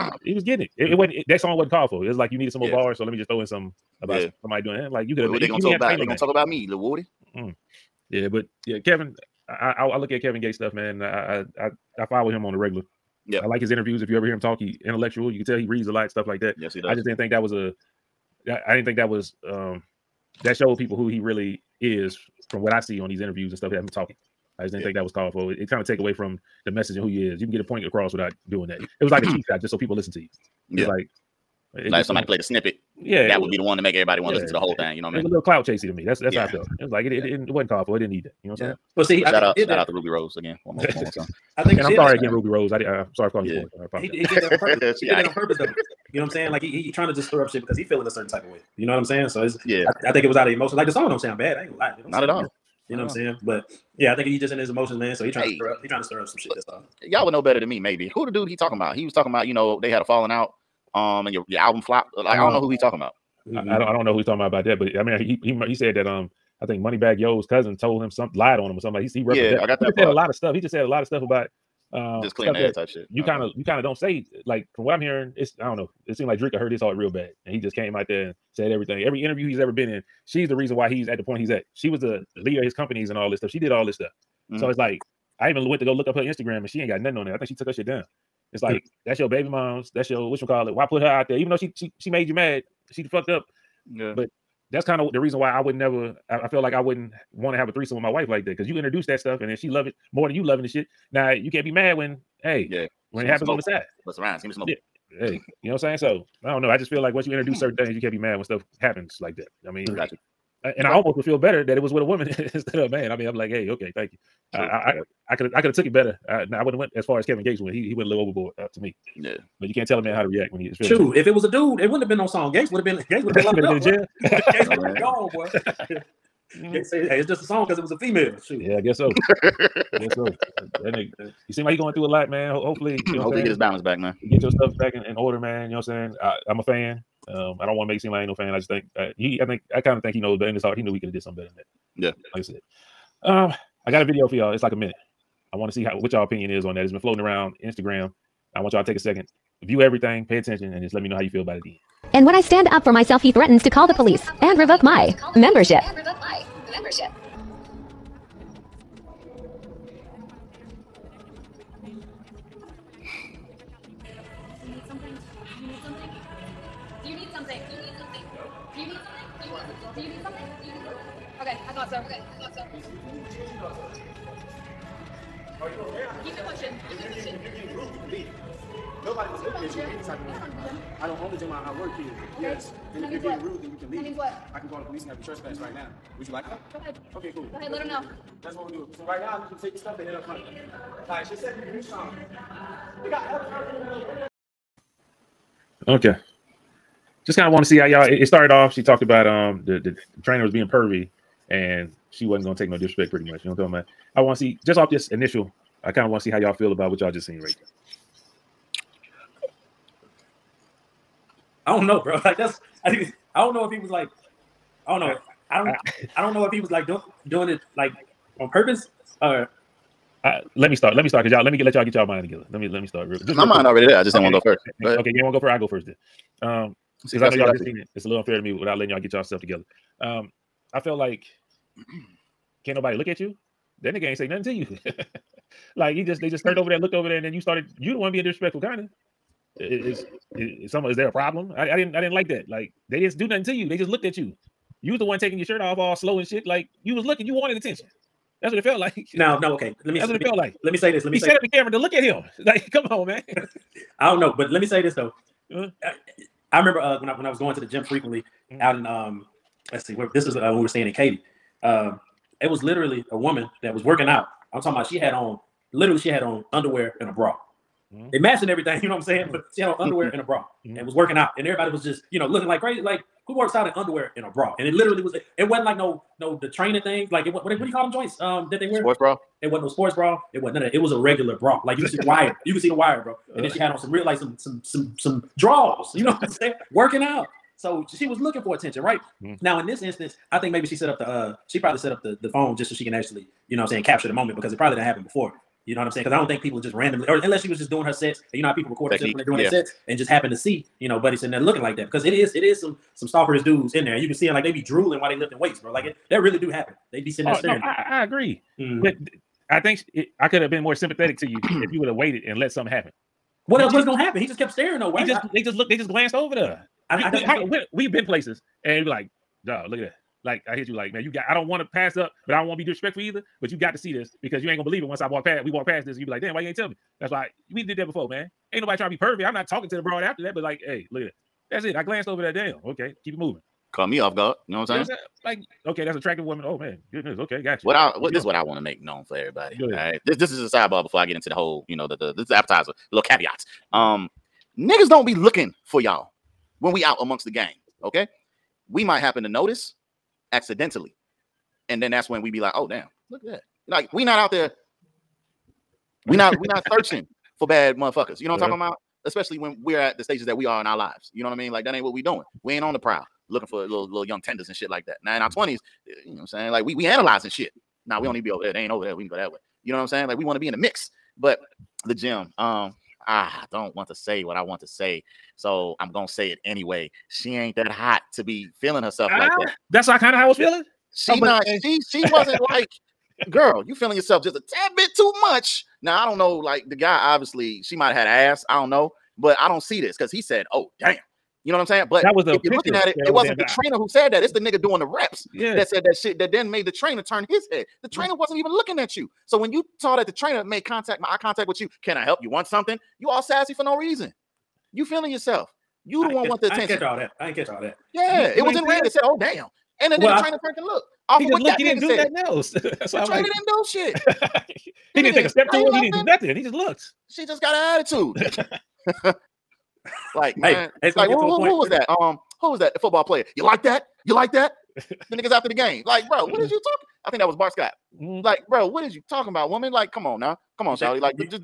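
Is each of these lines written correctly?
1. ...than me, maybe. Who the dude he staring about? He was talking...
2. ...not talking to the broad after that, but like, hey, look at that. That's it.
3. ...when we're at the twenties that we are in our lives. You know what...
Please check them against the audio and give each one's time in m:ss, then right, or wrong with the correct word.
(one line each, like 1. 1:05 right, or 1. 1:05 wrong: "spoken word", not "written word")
1. 0:57 wrong: "talking", not "staring"
2. 5:29 right
3. 5:59 wrong: "stages", not "twenties".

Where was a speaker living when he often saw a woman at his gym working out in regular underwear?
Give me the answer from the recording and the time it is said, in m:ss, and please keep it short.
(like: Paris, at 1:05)
Katy, at 4:20.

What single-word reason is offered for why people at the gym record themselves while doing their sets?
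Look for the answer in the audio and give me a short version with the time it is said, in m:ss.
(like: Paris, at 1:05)
Technique, at 4:58.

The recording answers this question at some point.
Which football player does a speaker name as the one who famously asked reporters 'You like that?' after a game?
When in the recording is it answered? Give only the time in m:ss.
7:07.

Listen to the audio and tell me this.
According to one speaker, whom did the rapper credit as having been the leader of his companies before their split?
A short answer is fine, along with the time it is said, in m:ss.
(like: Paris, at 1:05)
Dreka, at 1:16.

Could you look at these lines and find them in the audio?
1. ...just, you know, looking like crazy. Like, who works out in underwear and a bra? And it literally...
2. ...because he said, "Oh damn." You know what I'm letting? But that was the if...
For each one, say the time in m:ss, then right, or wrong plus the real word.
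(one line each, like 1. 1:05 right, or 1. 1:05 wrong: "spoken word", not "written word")
1. 4:31 right
2. 6:29 wrong: "saying", not "letting".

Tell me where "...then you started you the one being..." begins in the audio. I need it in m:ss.
3:57.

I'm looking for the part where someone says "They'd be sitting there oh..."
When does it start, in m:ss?
5:06.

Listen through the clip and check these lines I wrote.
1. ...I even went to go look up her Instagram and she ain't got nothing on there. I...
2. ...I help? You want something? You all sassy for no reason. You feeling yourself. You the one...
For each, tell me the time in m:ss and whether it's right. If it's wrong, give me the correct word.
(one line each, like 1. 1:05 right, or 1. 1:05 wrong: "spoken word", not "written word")
1. 1:25 right
2. 6:41 right.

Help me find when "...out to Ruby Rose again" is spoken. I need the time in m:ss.
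0:39.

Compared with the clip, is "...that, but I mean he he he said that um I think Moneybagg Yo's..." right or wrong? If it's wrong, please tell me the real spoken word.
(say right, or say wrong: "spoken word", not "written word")
right.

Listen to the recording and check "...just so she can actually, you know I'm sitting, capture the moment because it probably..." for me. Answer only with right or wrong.
wrong.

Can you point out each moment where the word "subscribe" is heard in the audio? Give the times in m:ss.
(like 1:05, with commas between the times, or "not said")
not said.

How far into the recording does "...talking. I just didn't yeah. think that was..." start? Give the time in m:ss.
0:23.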